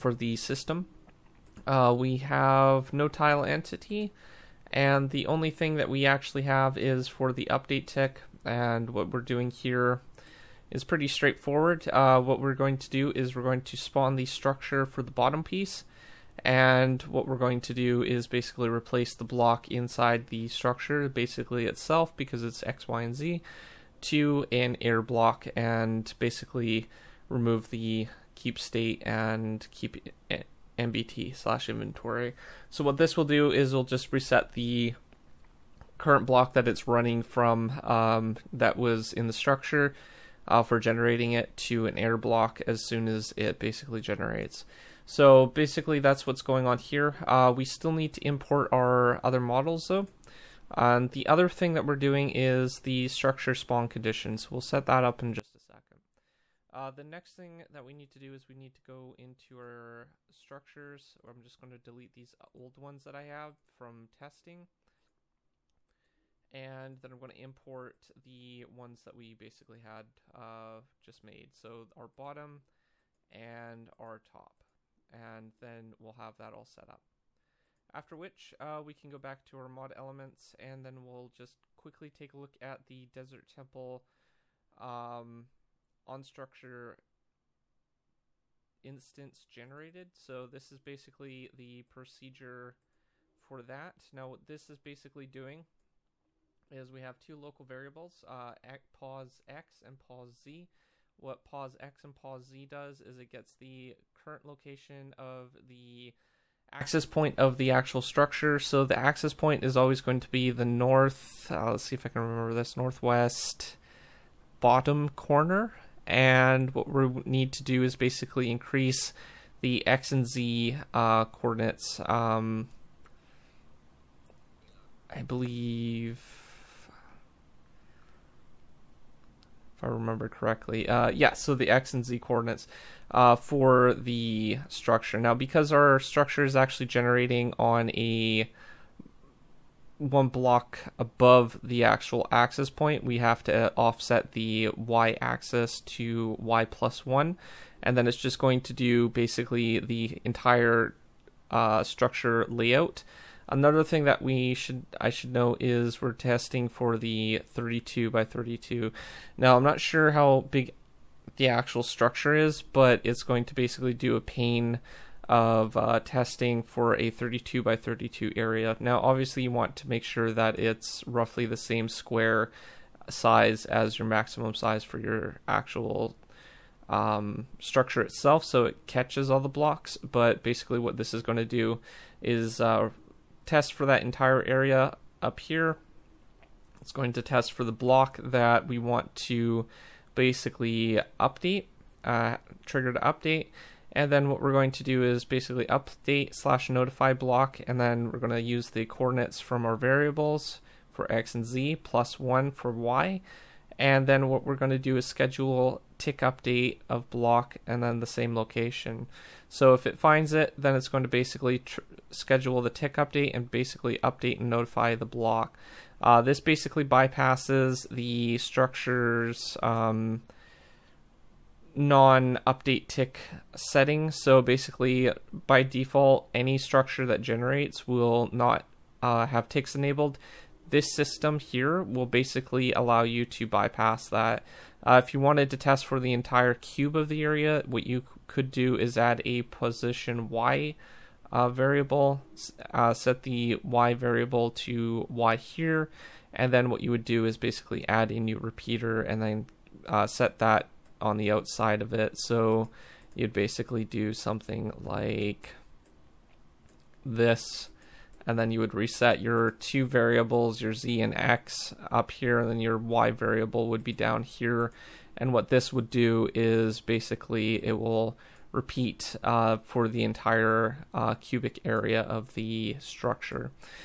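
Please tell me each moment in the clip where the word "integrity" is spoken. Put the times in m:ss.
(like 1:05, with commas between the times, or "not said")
not said.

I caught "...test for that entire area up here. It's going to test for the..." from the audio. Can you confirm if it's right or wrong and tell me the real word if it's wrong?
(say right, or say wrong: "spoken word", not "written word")
right.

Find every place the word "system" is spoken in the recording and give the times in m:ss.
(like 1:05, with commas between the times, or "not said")
0:00, 3:50.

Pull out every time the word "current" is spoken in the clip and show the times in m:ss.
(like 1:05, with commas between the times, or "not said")
0:35, 1:44.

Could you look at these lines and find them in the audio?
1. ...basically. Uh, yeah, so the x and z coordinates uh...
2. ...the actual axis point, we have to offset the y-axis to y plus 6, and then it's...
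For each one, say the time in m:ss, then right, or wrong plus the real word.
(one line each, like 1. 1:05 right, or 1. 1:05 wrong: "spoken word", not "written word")
1. 2:10 wrong: "correctly", not "basically"
2. 2:21 wrong: "1", not "6".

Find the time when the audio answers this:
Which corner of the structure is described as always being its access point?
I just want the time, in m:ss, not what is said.
1:52.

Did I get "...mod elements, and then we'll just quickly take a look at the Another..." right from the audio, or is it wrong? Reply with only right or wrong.
wrong.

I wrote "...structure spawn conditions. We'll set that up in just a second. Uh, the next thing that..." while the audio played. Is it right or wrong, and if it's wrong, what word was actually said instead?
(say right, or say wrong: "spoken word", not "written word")
right.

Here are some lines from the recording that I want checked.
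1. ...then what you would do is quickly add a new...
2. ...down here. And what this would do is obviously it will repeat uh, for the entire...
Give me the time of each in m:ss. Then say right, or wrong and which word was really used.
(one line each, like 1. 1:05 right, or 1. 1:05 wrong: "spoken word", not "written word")
1. 4:06 wrong: "basically", not "quickly"
2. 4:23 wrong: "basically", not "obviously".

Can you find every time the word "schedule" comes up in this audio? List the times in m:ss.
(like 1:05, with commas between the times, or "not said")
3:25, 3:32.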